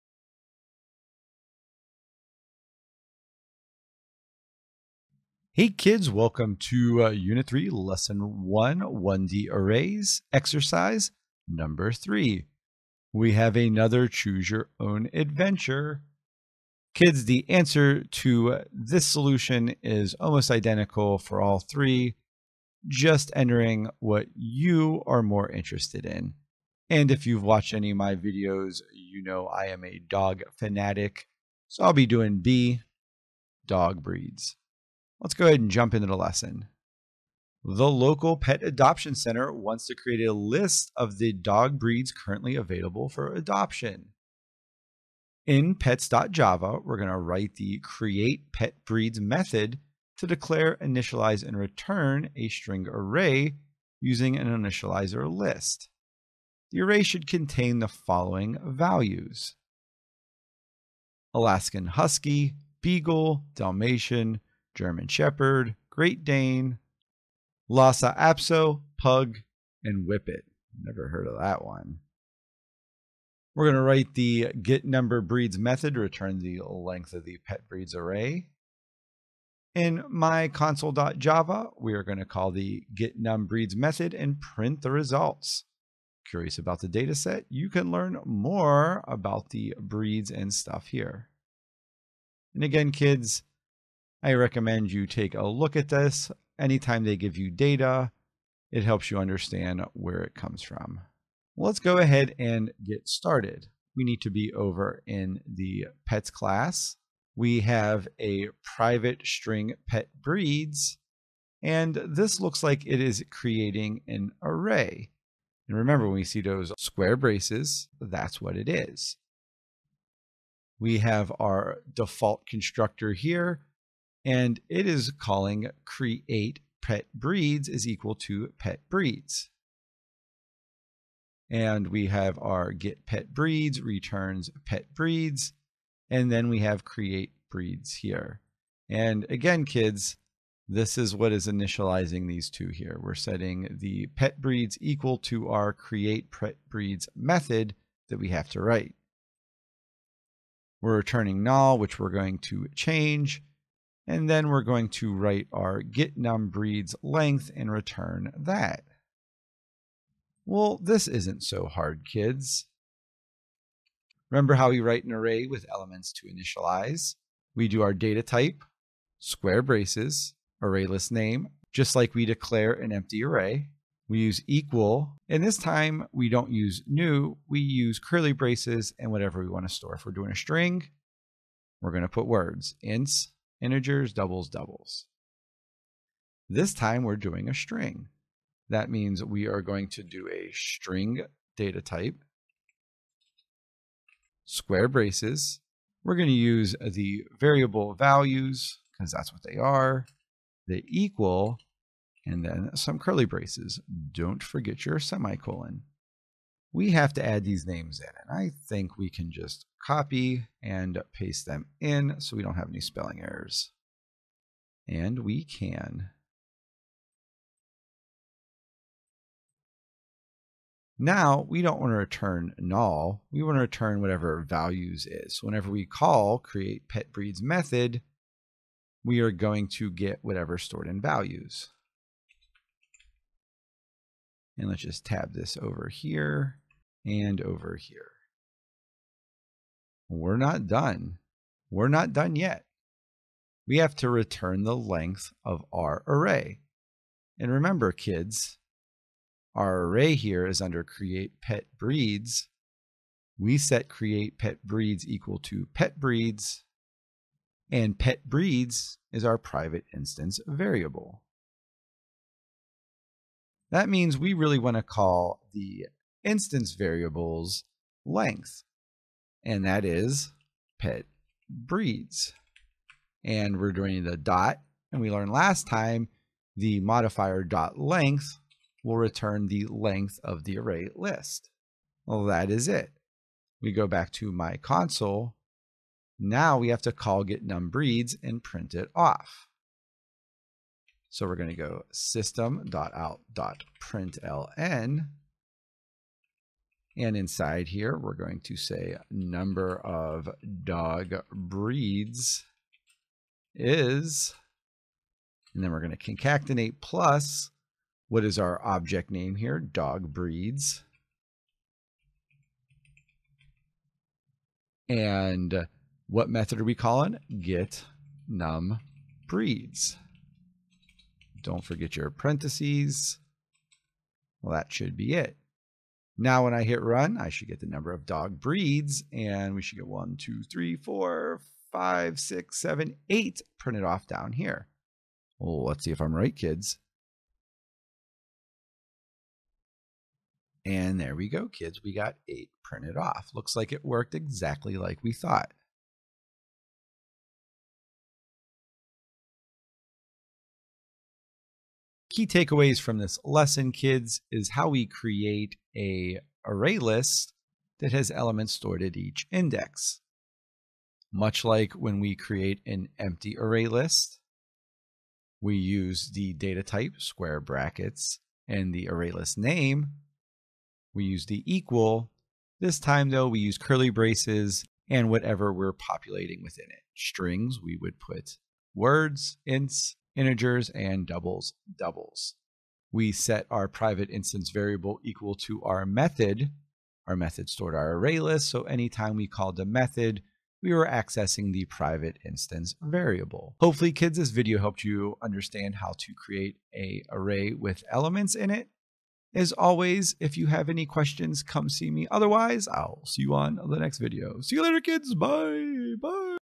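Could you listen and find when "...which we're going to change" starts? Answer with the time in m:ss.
2:31.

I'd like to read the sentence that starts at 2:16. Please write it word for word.
And then we have create breeds here.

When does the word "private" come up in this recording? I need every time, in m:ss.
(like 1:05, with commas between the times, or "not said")
1:48, 4:19, 6:23, 6:31.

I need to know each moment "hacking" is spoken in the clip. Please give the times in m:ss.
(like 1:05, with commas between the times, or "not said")
not said.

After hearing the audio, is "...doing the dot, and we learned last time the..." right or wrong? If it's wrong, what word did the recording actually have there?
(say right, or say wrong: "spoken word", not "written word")
right.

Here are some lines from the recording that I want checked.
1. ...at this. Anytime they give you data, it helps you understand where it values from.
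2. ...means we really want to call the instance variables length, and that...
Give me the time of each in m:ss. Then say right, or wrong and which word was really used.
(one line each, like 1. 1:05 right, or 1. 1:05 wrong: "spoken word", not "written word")
1. 1:35 wrong: "comes", not "values"
2. 4:23 right.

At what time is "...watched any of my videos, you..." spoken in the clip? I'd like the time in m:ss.
0:27.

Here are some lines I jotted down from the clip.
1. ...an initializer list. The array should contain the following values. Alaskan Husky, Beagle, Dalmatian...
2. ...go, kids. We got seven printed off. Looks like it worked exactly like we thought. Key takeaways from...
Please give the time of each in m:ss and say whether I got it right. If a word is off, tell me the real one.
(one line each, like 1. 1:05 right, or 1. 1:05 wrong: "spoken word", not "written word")
1. 0:54 right
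2. 5:41 wrong: "eight", not "seven".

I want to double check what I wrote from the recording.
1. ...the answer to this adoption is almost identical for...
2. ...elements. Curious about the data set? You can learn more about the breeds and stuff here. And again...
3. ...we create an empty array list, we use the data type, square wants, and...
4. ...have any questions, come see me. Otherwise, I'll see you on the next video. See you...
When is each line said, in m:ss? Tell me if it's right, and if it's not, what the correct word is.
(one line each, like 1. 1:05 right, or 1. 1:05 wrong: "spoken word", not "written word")
1. 0:17 wrong: "solution", not "adoption"
2. 1:24 wrong: "results", not "elements"
3. 6:02 wrong: "brackets", not "wants"
4. 6:40 right.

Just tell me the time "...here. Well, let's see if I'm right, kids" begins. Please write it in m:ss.
5:34.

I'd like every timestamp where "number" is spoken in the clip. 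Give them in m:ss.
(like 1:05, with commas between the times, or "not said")
0:11, 1:14, 4:59, 5:27.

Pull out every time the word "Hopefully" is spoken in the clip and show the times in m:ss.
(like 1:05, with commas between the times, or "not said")
6:33.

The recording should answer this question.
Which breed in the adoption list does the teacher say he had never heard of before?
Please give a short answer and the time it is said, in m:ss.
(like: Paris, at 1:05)
Whippet, at 1:10.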